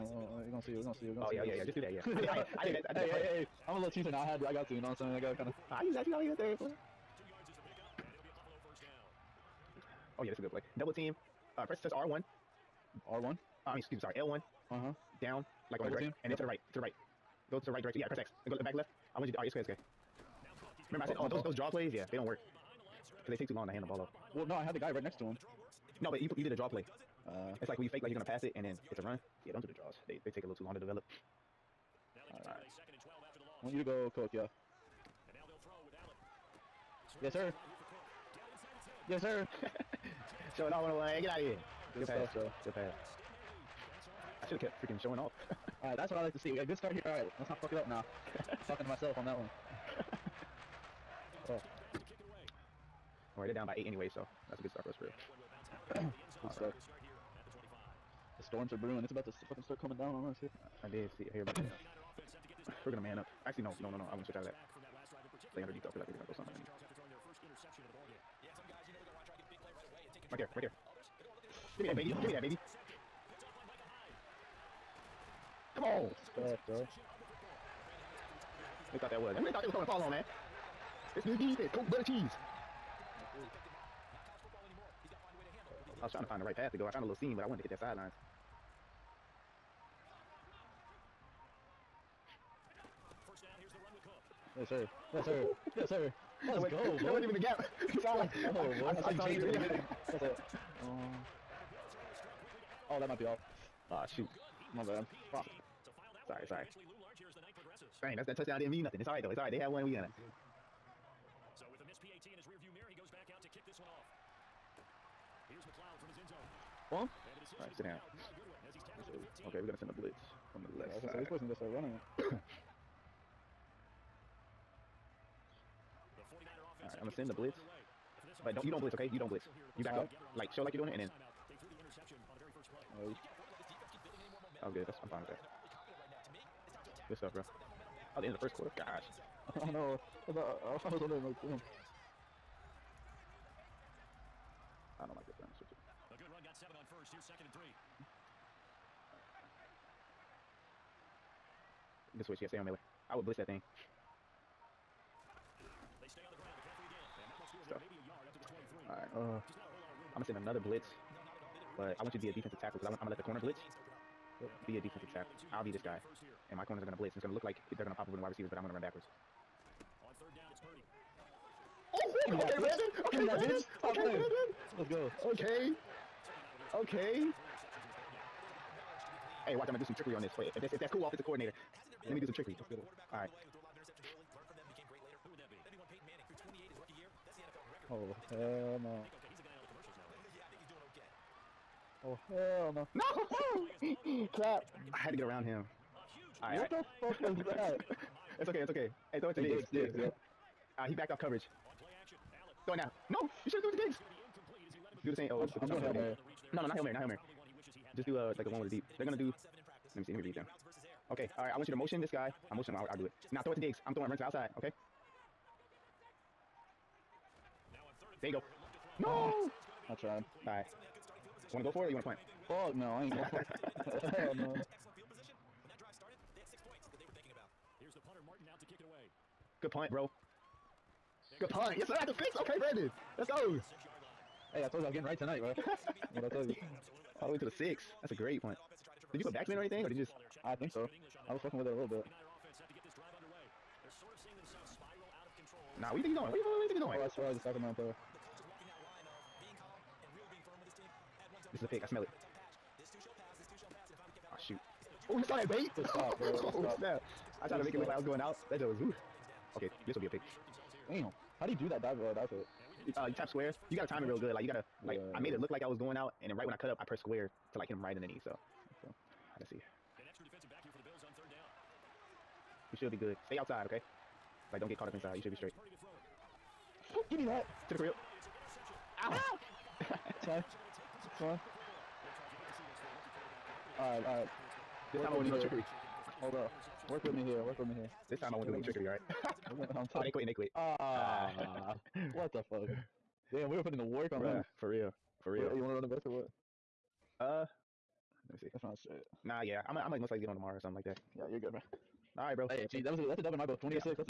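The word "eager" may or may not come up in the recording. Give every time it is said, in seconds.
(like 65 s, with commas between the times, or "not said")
not said.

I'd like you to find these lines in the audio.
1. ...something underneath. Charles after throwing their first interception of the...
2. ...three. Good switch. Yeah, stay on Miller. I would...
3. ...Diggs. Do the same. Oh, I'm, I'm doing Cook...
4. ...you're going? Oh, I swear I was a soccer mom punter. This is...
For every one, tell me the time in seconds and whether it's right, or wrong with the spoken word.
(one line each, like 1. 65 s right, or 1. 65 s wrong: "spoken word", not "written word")
1. 66 s right
2. 147 s right
3. 203 s wrong: "Hail", not "Cook"
4. 246 s wrong: "player", not "punter".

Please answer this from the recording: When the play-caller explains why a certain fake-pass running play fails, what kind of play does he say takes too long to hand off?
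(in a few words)
Draw plays.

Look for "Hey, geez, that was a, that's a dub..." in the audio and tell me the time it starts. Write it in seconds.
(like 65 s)
302 s.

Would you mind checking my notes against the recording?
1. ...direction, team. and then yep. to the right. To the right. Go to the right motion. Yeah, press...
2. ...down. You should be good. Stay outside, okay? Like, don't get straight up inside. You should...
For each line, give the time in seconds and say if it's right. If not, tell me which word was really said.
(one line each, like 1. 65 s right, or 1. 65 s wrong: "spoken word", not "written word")
1. 15 s wrong: "direction", not "motion"
2. 271 s wrong: "caught", not "straight".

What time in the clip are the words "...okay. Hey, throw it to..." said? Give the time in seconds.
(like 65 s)
198 s.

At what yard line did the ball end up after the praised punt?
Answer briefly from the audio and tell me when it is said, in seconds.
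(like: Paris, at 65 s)
6, at 231 s.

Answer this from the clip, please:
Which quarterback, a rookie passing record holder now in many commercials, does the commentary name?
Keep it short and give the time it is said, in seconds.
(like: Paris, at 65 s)
Peyton Manning, at 185 s.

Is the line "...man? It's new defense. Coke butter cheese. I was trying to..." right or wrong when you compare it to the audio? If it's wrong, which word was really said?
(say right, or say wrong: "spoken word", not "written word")
right.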